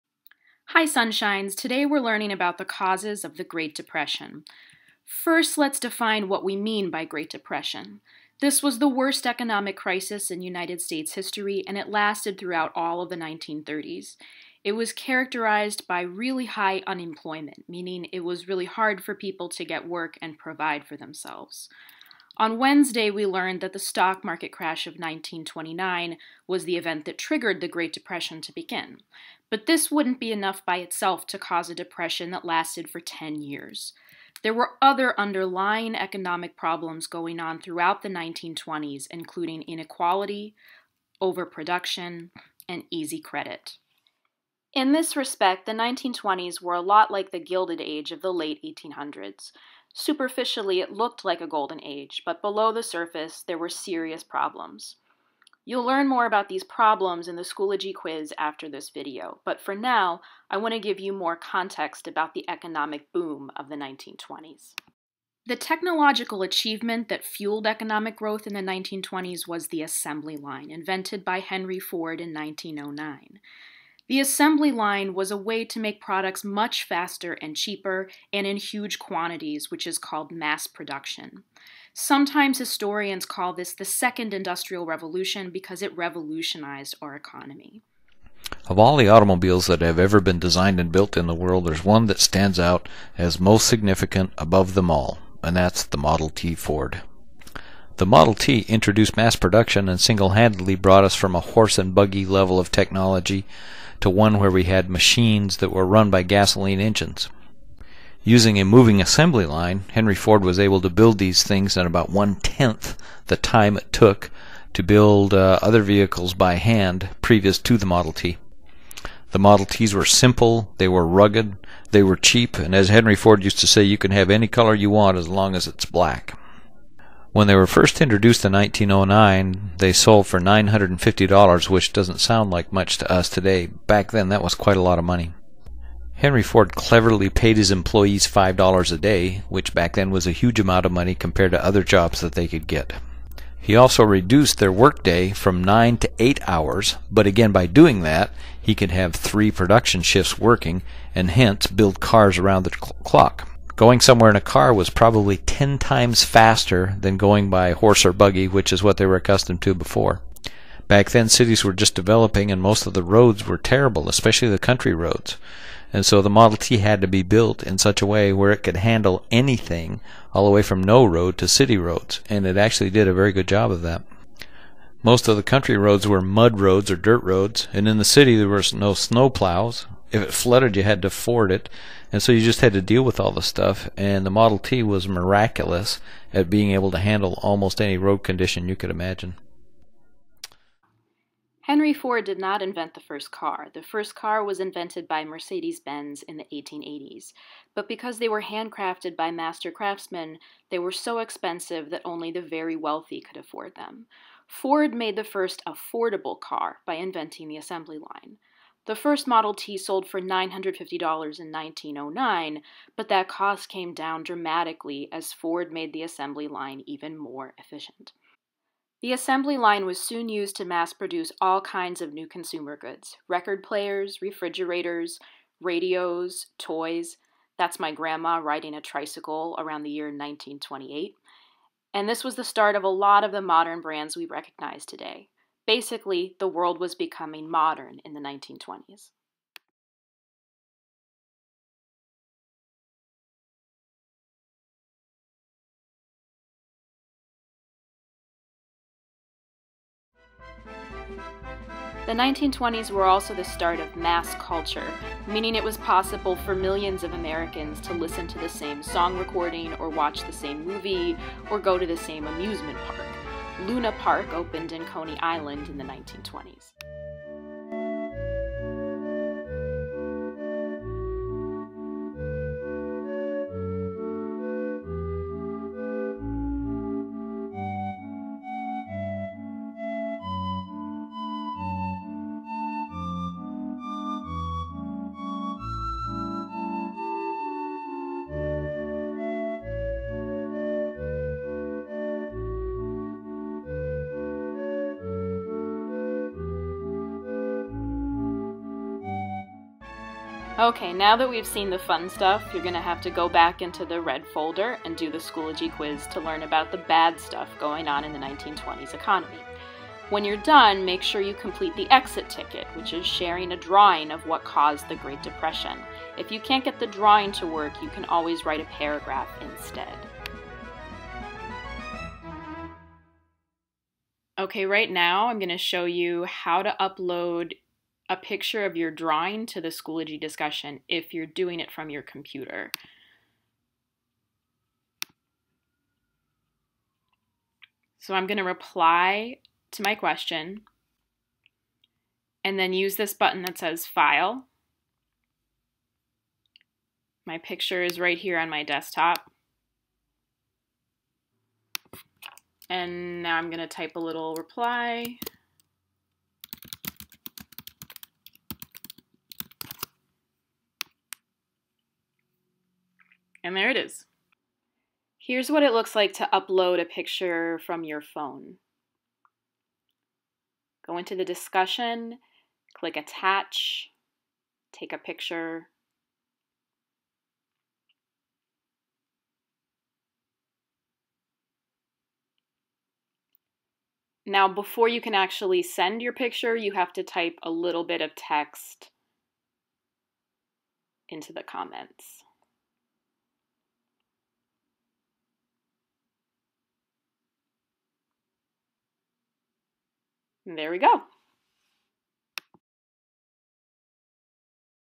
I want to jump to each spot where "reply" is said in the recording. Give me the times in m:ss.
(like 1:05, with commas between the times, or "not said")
5:38, 5:54.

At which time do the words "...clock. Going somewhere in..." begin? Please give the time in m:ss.
2:33.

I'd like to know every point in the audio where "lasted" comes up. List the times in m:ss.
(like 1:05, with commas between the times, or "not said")
0:11, 0:32.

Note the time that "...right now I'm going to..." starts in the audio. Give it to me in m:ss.
5:24.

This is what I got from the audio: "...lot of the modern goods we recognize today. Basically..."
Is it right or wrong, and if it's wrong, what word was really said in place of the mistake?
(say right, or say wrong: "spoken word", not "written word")
wrong: "brands", not "goods".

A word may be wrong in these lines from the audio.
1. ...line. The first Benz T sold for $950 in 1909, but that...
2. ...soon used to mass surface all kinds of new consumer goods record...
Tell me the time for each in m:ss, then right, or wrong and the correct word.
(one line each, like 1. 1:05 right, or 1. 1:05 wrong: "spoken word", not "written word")
1. 3:27 wrong: "Model", not "Benz"
2. 3:40 wrong: "produce", not "surface".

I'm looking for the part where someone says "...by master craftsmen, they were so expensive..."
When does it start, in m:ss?
3:19.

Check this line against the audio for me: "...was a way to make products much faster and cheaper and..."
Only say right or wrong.
right.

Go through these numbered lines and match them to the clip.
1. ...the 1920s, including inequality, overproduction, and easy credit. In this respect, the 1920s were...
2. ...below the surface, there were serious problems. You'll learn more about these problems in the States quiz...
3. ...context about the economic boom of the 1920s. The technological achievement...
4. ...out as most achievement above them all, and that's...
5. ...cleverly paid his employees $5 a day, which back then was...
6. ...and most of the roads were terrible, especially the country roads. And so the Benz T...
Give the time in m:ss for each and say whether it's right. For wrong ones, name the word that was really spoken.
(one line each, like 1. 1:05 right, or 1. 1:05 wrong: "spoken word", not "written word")
1. 0:38 right
2. 0:52 wrong: "Schoology", not "States"
3. 1:01 right
4. 1:32 wrong: "significant", not "achievement"
5. 2:16 right
6. 2:42 wrong: "Model", not "Benz".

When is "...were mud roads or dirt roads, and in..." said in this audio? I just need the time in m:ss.
2:56.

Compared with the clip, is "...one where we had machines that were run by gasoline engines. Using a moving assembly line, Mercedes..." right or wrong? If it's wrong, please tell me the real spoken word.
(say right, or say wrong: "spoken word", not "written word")
wrong: "Henry", not "Mercedes".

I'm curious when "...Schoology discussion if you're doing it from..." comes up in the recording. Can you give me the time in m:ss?
5:29.